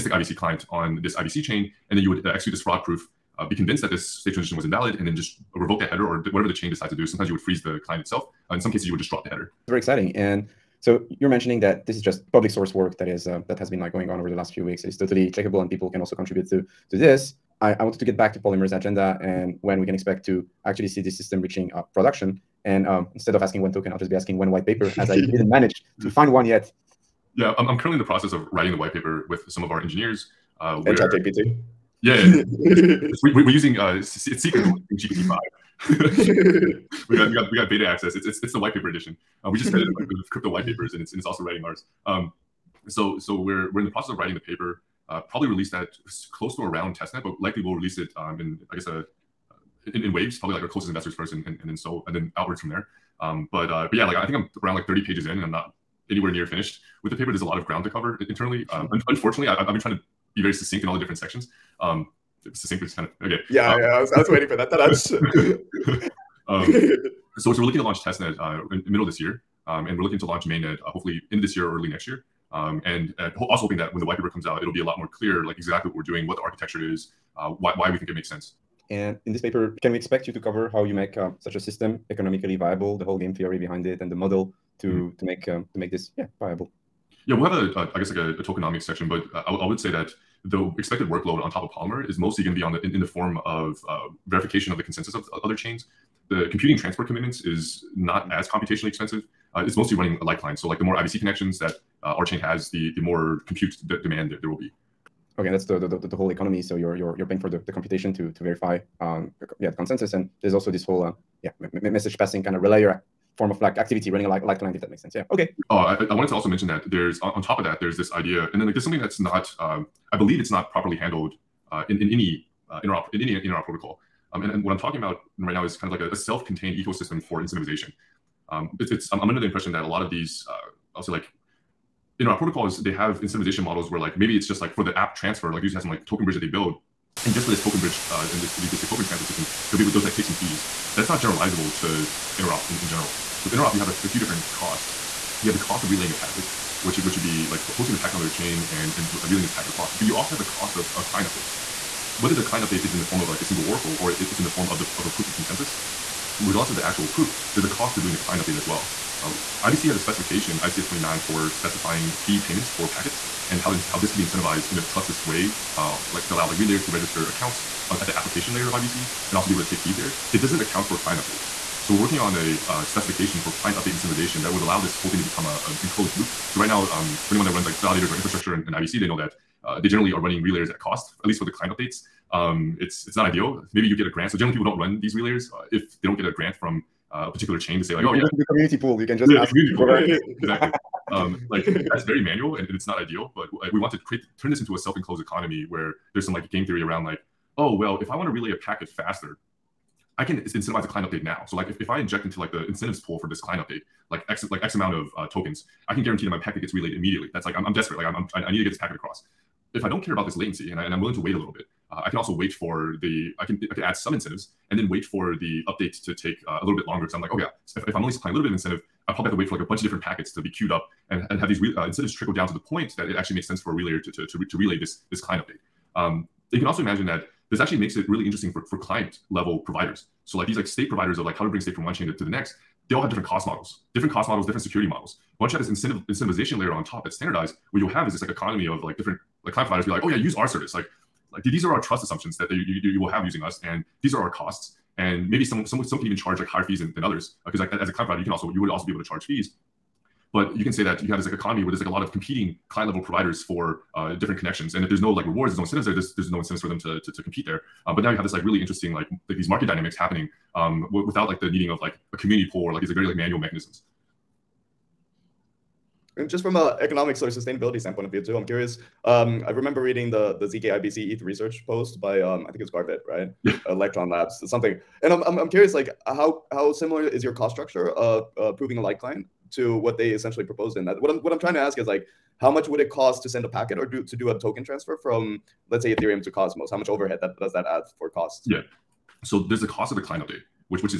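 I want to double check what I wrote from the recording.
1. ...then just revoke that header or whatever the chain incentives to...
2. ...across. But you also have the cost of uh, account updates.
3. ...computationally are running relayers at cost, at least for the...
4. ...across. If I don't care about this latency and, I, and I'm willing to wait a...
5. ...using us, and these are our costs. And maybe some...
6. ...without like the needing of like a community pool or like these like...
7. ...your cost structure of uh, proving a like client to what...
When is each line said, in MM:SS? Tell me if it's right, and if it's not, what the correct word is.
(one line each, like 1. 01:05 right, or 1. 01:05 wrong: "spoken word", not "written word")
1. 00:05 wrong: "decides", not "incentives"
2. 02:29 wrong: "client", not "account"
3. 02:59 wrong: "generally", not "computationally"
4. 03:28 right
5. 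04:03 right
6. 04:21 right
7. 04:37 right.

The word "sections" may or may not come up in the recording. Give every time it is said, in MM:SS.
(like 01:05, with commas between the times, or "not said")
01:01, 01:28.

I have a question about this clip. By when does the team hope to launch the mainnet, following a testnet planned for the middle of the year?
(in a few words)
End of this year.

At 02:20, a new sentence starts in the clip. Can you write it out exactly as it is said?
That's not generalizable to interop in, in general.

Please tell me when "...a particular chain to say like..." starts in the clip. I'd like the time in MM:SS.
03:07.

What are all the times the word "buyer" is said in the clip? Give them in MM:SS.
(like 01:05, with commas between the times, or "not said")
not said.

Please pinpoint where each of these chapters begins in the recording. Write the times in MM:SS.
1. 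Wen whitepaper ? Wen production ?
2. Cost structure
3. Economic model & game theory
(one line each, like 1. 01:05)
1. 00:22
2. 04:39
3. 01:32.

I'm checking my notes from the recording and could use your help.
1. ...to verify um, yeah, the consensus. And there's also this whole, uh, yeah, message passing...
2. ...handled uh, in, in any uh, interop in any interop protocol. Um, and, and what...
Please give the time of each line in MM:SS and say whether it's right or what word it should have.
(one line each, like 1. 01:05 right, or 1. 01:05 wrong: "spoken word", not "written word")
1. 01:48 right
2. 02:00 right.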